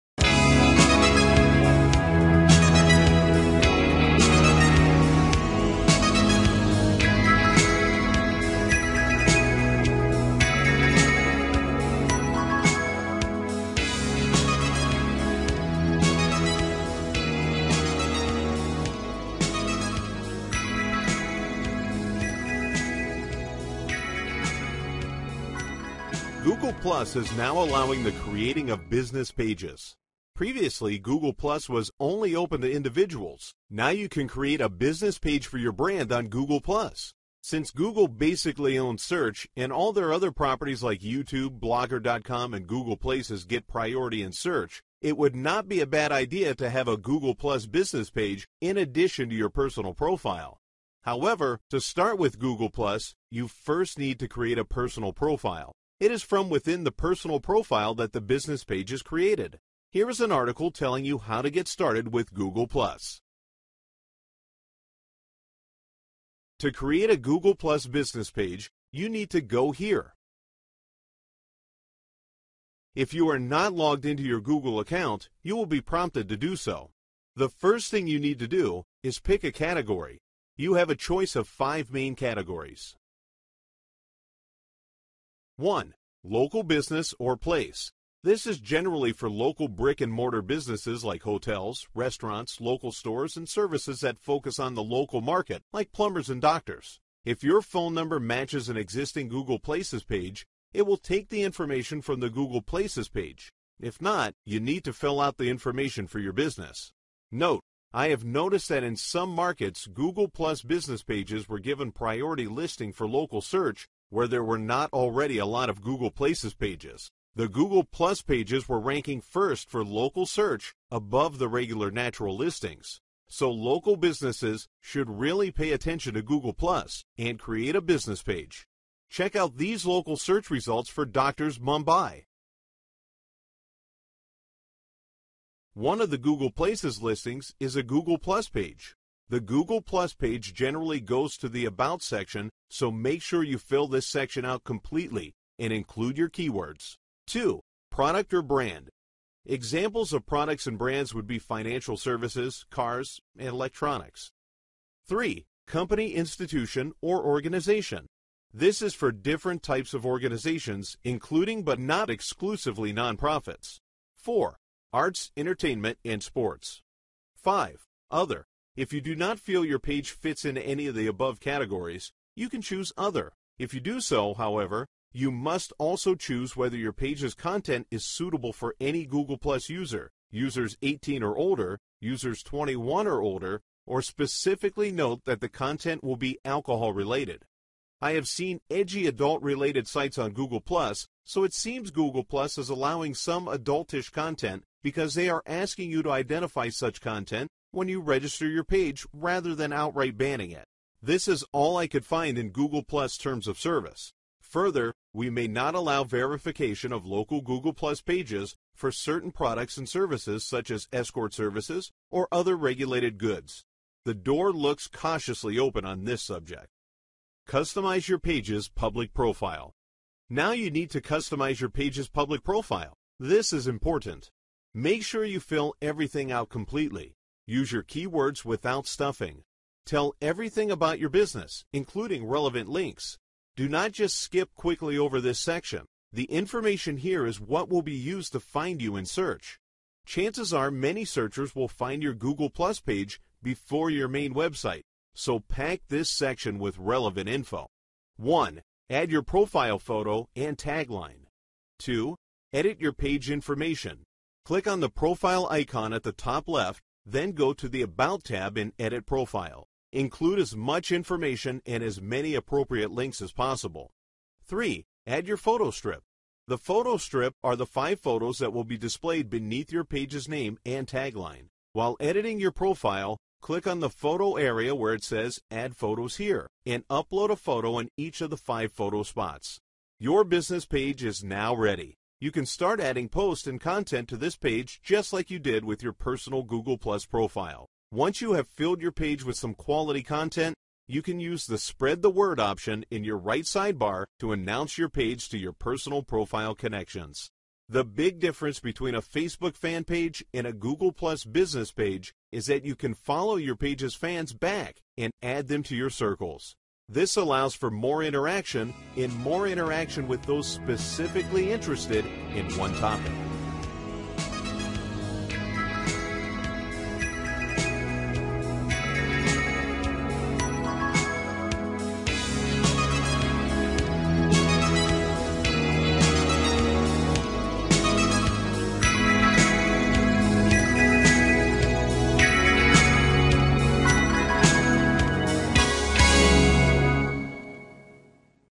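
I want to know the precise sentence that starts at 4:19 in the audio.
Include as much information and as many appropriate links as possible.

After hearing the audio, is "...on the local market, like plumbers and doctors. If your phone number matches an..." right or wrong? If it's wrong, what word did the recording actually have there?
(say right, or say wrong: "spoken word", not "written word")
right.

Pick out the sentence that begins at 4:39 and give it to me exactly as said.
Your business page is now ready.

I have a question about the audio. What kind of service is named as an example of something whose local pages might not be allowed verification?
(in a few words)
escort services.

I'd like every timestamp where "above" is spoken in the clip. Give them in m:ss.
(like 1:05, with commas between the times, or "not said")
2:00, 2:51.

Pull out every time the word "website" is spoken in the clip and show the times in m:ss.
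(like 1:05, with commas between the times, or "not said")
4:04.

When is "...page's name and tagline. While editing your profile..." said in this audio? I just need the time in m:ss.
4:29.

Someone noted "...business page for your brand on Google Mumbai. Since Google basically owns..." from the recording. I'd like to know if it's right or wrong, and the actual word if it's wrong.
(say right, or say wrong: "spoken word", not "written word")
wrong: "Plus", not "Mumbai".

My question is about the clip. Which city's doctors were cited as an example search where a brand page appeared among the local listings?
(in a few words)
Mumbai.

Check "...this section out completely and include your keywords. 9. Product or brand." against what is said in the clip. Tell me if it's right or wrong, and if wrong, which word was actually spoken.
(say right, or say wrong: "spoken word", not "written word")
wrong: "2", not "9".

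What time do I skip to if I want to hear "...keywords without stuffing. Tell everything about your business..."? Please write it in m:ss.
3:47.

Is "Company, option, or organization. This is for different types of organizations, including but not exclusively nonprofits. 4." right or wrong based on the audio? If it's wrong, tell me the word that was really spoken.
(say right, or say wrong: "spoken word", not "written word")
wrong: "institution", not "option".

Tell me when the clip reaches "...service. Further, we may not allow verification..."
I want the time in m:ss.
3:23.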